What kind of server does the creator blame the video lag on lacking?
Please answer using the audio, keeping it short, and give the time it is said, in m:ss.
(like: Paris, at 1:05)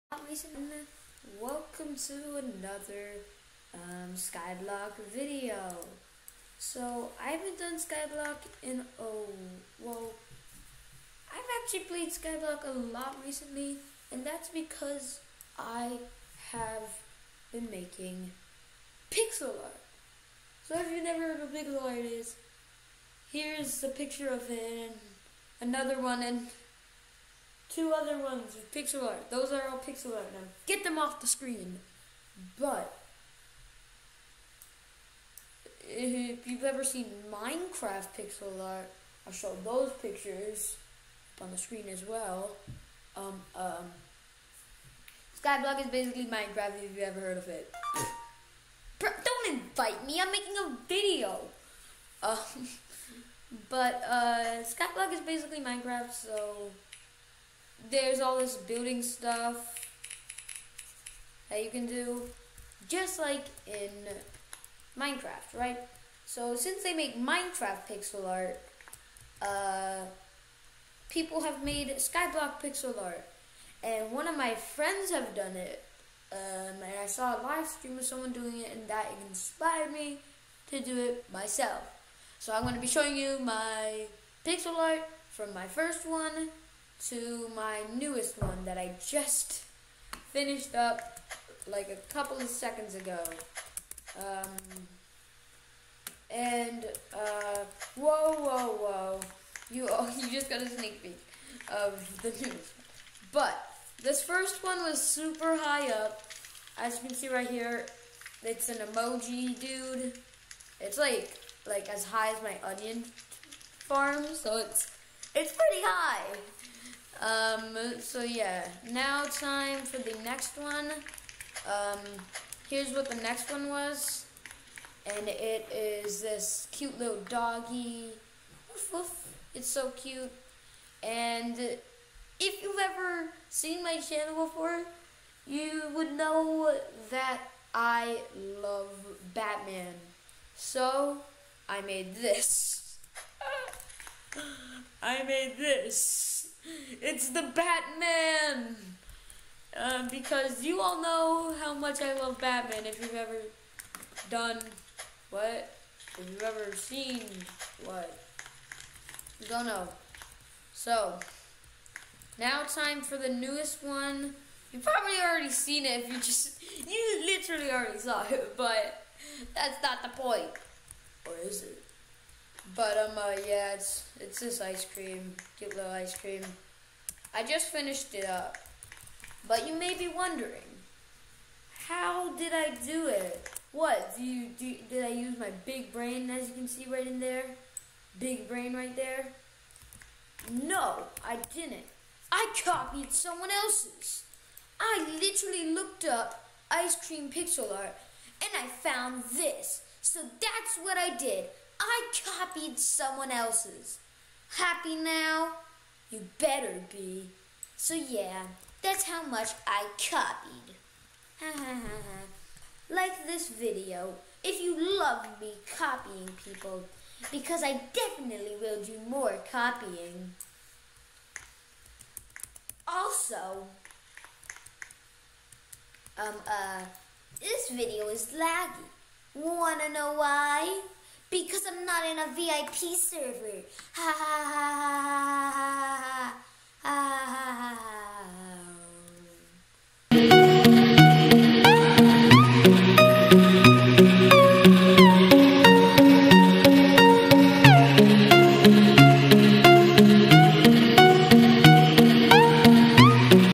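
VIP server, at 3:52.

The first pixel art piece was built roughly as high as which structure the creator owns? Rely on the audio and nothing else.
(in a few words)
Onion farm.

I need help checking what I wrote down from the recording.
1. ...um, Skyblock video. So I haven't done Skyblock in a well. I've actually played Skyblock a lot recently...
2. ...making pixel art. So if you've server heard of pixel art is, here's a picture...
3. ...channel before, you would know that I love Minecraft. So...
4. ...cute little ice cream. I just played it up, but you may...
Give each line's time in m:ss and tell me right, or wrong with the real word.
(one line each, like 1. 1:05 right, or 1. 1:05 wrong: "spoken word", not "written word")
1. 0:03 right
2. 0:17 wrong: "never", not "server"
3. 2:13 wrong: "Batman", not "Minecraft"
4. 2:55 wrong: "finished", not "played".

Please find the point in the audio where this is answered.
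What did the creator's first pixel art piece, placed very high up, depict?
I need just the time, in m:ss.
1:48.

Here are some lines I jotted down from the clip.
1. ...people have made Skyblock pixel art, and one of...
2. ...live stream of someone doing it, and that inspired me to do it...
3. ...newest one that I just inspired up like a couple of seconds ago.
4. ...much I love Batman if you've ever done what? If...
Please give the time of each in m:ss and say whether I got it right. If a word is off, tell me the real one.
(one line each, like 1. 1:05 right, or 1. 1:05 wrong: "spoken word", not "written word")
1. 1:11 right
2. 1:17 right
3. 1:27 wrong: "finished", not "inspired"
4. 2:31 right.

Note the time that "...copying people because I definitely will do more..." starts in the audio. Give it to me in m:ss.
3:35.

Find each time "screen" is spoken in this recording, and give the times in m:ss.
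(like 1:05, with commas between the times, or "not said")
0:31, 0:41.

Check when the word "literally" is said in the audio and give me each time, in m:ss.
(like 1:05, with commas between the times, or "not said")
2:47, 3:15.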